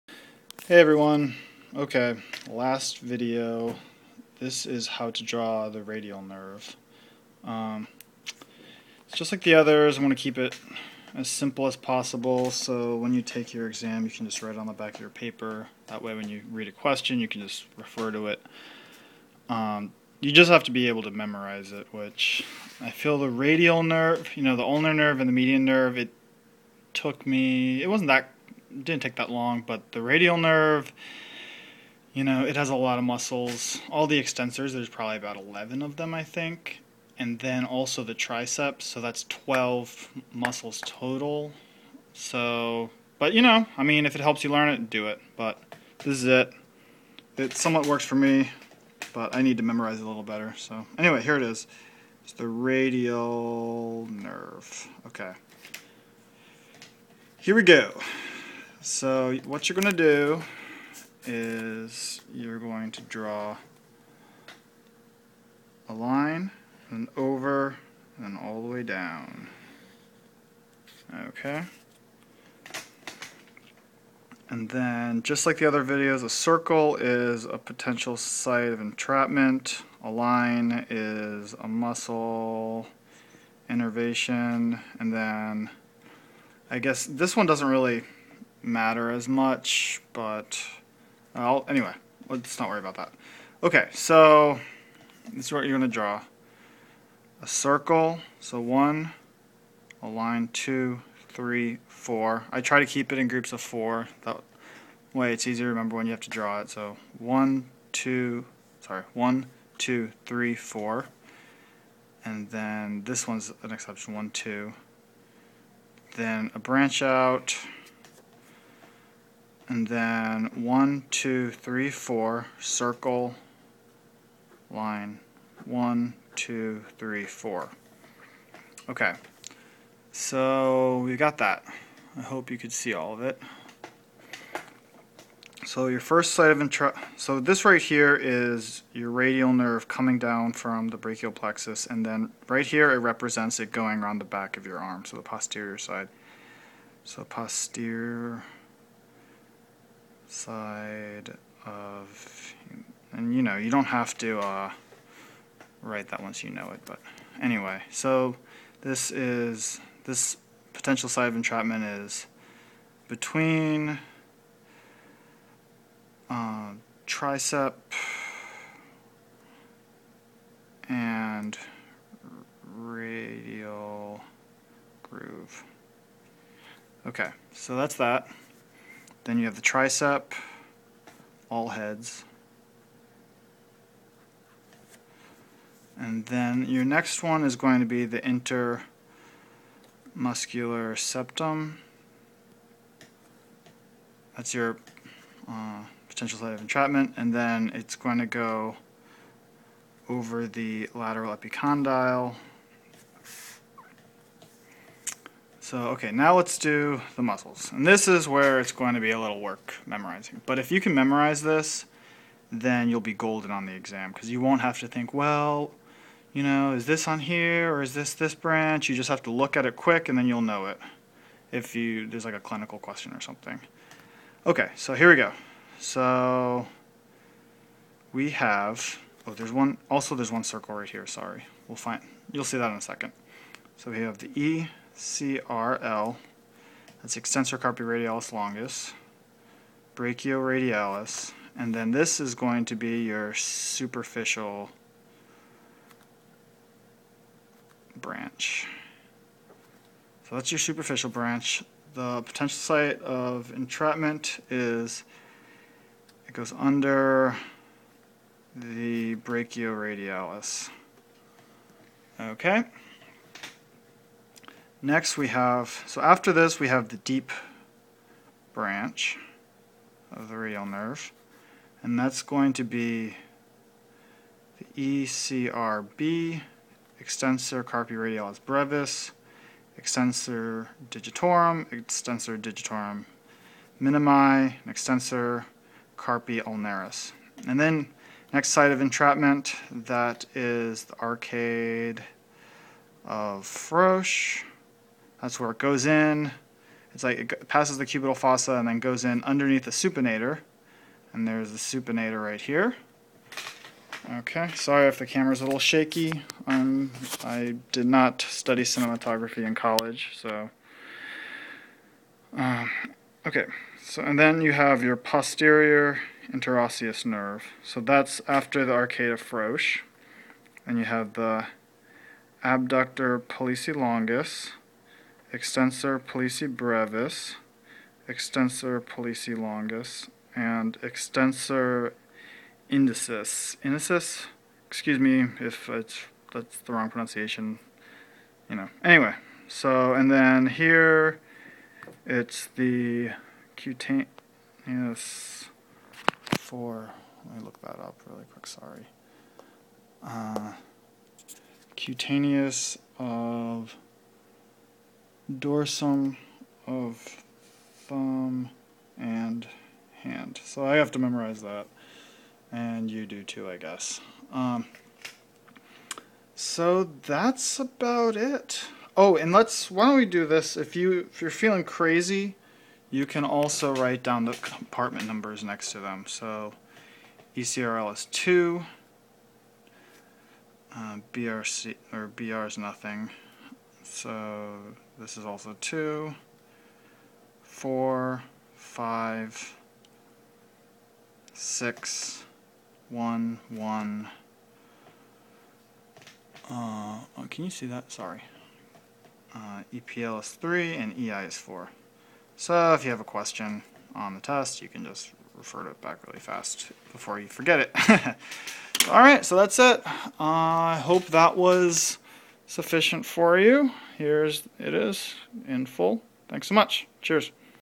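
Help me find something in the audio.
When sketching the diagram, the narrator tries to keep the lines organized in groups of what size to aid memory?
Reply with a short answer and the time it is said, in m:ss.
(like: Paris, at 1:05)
4, at 1:43.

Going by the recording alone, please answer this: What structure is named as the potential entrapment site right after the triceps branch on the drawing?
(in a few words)
Intermuscular septum.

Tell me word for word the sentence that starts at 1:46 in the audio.
So one, two, sorry, one, two, three, four.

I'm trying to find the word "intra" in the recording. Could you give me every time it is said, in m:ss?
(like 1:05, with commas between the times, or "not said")
2:16.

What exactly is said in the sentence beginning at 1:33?
Okay, so this is what you're going to draw.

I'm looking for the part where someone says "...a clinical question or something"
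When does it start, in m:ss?
3:42.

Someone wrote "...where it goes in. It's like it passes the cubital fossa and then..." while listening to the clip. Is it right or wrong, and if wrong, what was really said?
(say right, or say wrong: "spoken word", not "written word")
right.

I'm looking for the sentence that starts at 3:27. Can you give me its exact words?
And this is where it's going to be a little work memorizing.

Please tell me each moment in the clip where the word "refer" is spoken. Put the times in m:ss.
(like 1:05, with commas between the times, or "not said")
0:17, 6:45.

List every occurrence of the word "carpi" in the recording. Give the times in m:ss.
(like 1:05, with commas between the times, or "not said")
3:57, 4:37, 4:45.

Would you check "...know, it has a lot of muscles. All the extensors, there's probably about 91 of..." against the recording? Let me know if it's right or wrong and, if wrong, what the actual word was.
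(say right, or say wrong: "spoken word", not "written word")
wrong: "11", not "91".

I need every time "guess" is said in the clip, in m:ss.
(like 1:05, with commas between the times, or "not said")
1:26, 6:03.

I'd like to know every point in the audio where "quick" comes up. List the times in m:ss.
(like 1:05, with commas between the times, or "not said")
3:39, 5:48.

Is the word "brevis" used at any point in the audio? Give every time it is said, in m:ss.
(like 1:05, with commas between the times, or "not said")
4:38, 5:26.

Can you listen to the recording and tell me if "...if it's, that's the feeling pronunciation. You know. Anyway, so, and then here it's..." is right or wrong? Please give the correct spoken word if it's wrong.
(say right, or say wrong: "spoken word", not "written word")
wrong: "wrong", not "feeling".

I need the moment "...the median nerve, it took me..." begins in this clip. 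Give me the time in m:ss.
0:25.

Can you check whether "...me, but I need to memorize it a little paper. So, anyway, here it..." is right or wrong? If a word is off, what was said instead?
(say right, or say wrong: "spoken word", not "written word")
wrong: "better", not "paper".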